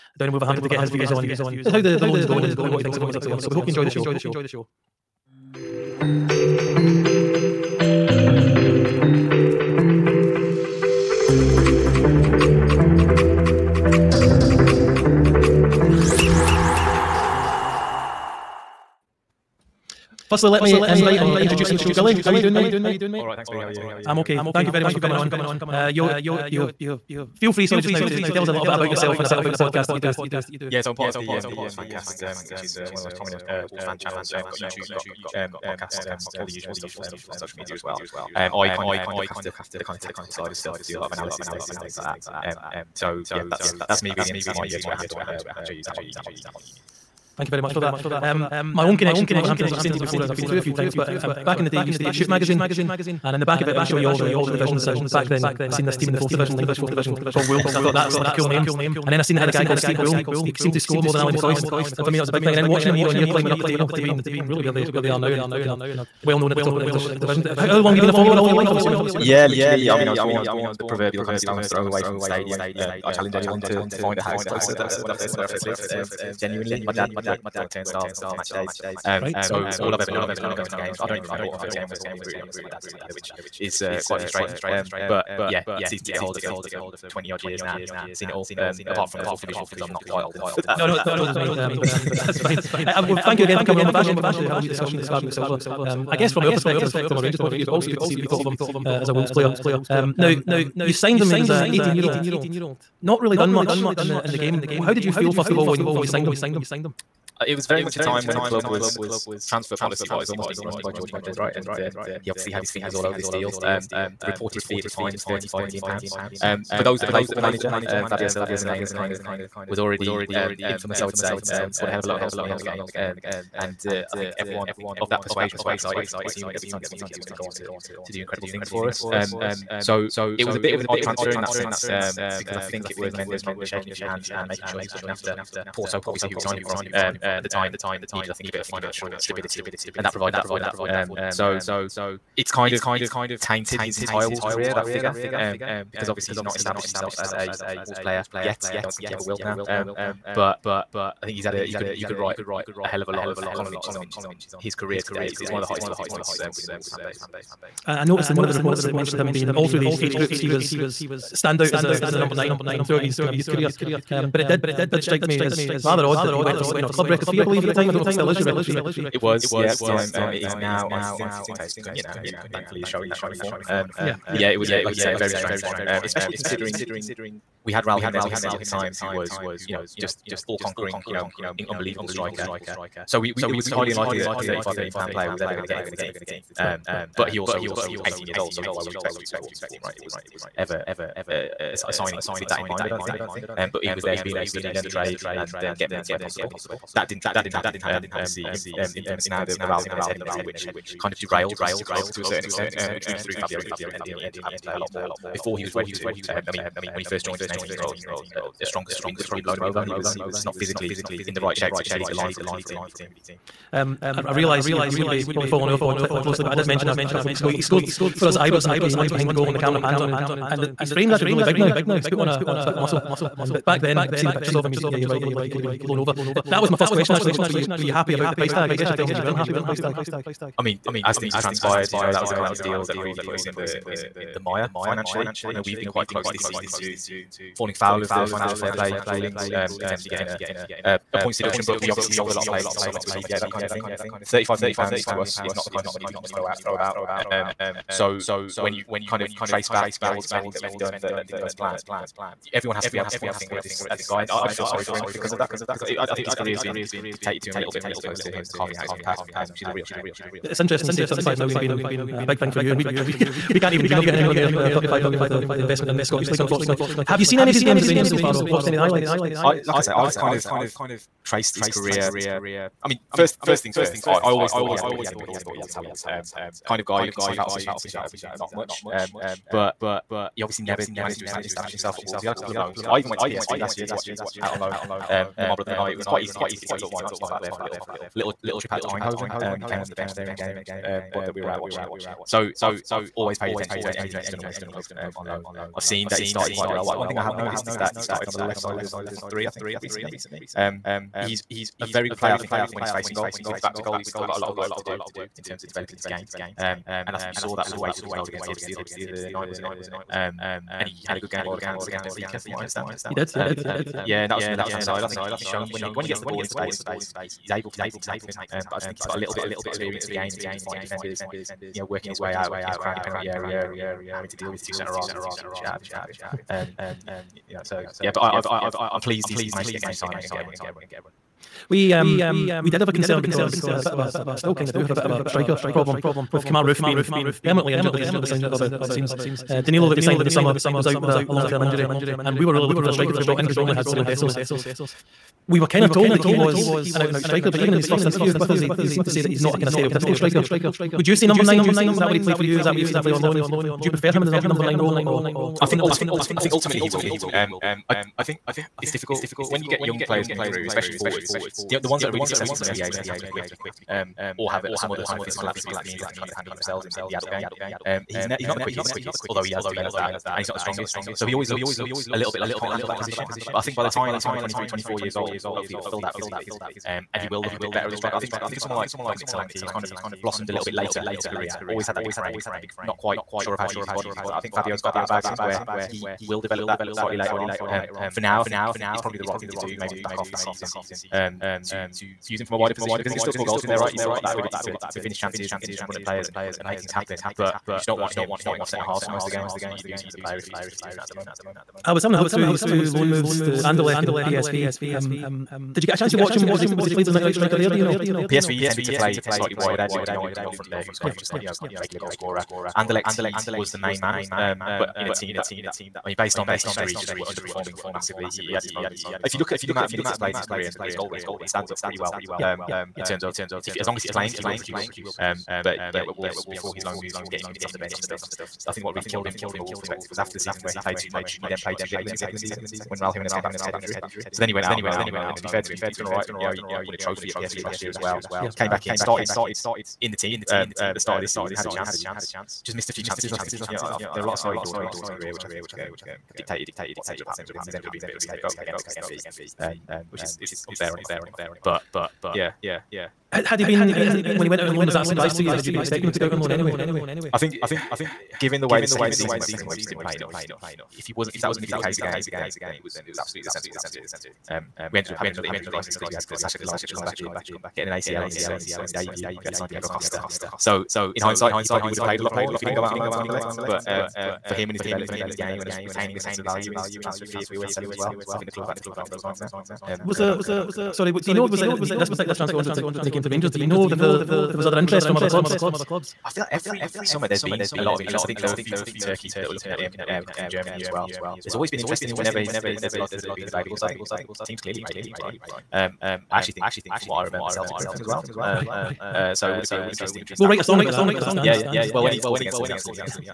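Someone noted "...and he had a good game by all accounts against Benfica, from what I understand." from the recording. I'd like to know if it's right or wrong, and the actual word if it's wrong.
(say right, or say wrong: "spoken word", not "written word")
right.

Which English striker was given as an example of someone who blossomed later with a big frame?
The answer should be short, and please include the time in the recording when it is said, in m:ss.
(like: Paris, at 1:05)
Dominic Solanke, at 6:19.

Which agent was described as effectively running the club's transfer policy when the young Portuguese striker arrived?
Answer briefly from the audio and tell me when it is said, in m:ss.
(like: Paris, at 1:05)
George Mendes, at 1:50.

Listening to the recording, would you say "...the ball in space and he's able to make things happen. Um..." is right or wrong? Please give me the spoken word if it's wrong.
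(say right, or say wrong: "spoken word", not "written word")
right.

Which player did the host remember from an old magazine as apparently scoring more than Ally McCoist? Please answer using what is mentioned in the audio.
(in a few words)
Steve Bull.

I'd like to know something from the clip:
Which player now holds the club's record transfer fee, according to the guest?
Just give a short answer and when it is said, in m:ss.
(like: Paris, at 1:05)
Matheus Cunha, at 2:51.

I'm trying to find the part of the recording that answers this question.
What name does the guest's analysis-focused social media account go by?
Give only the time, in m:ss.
0:45.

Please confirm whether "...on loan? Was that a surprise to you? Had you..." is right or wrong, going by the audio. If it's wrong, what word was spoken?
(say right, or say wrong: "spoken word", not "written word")
right.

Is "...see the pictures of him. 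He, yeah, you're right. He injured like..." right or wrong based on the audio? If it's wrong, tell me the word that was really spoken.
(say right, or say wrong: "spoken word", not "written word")
wrong: "looked", not "injured".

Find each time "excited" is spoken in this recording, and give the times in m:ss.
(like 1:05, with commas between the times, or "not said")
2:05.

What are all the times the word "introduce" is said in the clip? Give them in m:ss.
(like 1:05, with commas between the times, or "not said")
0:21.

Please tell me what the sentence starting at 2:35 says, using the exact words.
It's, it's one of the hottest talking points um, within the Wolves fan base.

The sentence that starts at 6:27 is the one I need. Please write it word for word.
Um, for now, I think it's probably the right thing to do.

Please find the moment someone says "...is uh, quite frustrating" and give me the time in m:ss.
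1:23.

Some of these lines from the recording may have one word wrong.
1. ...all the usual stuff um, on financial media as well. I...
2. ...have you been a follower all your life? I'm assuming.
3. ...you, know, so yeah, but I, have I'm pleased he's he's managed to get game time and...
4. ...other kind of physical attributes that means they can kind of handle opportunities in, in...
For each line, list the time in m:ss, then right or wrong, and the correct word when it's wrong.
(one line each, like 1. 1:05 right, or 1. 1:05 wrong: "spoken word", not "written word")
1. 0:36 wrong: "social", not "financial"
2. 1:07 right
3. 5:27 right
4. 6:04 wrong: "themselves", not "opportunities".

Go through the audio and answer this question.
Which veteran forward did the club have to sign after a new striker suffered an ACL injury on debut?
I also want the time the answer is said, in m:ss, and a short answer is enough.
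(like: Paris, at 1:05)
Diego Costa, at 7:49.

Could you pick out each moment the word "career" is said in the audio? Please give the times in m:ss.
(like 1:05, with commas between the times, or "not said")
2:24, 2:34, 2:43, 4:16, 4:31, 6:21, 7:00, 7:25.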